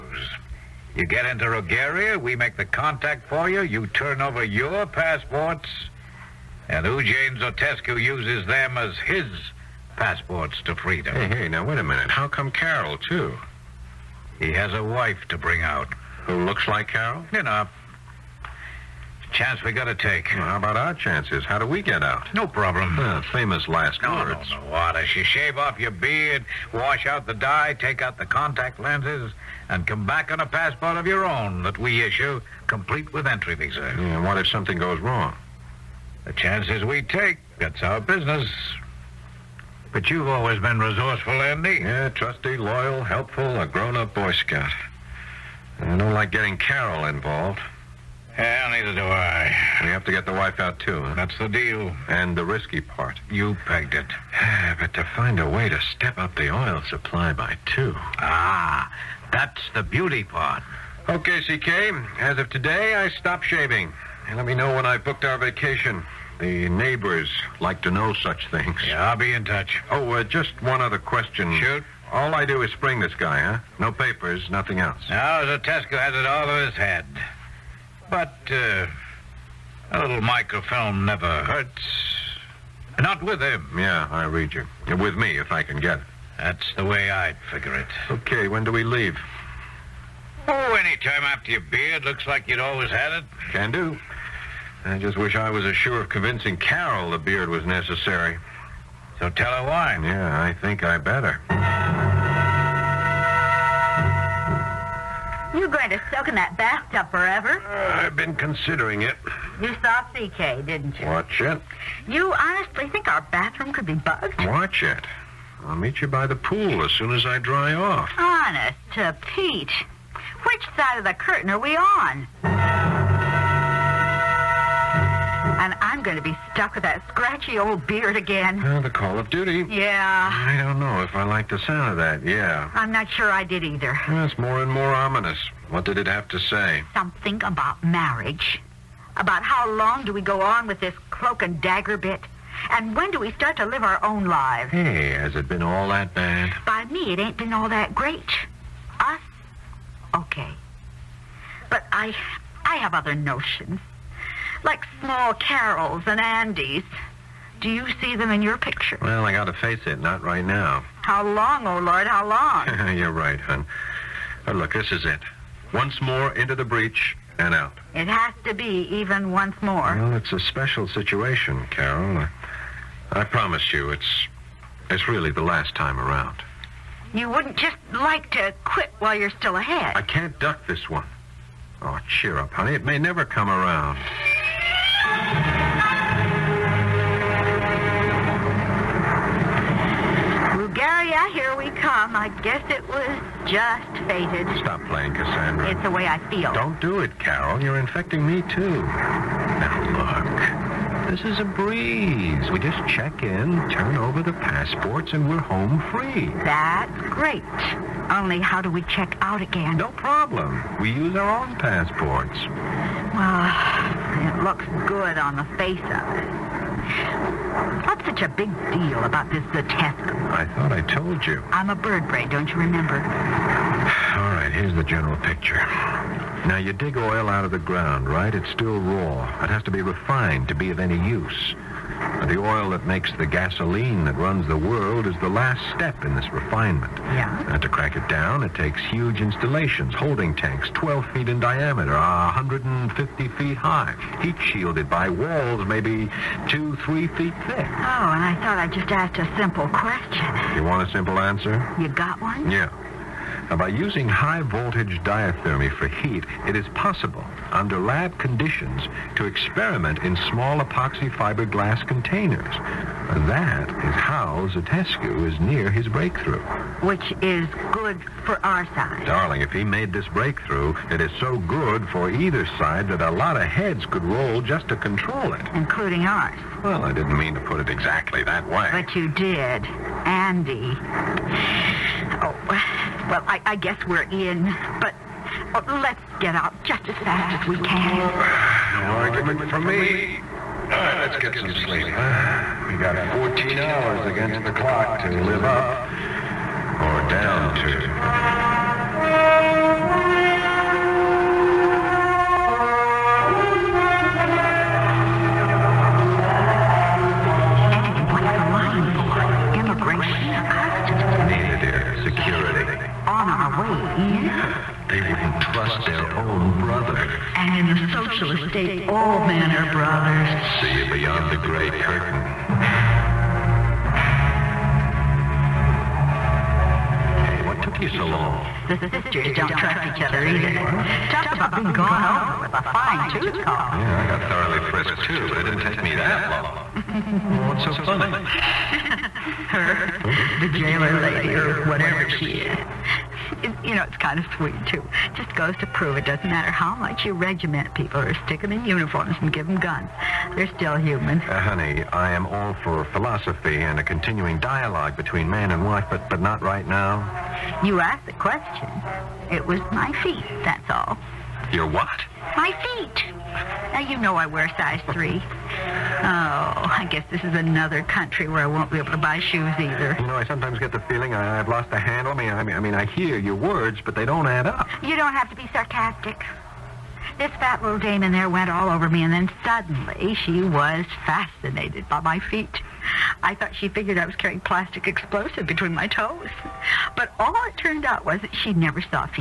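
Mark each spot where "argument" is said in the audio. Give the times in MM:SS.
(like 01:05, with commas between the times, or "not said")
04:48.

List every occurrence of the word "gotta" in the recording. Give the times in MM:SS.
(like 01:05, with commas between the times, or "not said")
00:19, 02:39.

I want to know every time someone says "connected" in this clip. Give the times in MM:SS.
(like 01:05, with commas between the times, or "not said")
not said.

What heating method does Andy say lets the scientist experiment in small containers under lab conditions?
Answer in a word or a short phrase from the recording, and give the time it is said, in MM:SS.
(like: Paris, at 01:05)
high voltage diathermy, at 04:14.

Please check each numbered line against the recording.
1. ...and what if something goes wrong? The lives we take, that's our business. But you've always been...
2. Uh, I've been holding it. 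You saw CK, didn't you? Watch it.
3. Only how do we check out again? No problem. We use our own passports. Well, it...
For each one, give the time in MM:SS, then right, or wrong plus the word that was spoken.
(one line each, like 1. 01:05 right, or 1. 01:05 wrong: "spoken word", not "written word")
1. 00:34 wrong: "chances", not "lives"
2. 01:47 wrong: "considering", not "holding"
3. 03:28 right.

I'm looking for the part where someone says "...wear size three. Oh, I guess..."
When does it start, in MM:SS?
06:04.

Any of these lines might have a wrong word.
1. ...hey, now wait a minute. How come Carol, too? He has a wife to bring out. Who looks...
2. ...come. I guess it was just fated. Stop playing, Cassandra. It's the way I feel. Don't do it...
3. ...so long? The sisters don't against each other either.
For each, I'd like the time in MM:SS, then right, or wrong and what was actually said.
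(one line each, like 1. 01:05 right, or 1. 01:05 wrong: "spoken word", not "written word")
1. 00:11 right
2. 03:11 right
3. 05:27 wrong: "trust", not "against".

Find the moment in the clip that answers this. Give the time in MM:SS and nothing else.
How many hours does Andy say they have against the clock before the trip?
04:53.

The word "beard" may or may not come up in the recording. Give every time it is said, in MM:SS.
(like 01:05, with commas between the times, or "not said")
00:25, 01:31, 01:37, 02:07.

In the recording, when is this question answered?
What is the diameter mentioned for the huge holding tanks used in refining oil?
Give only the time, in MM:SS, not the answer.
04:00.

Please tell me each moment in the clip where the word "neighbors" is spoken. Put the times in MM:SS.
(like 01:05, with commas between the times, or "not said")
01:06.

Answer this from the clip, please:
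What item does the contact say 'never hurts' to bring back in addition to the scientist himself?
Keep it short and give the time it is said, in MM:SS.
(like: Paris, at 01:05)
microfilm, at 01:20.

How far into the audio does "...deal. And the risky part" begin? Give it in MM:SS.
00:51.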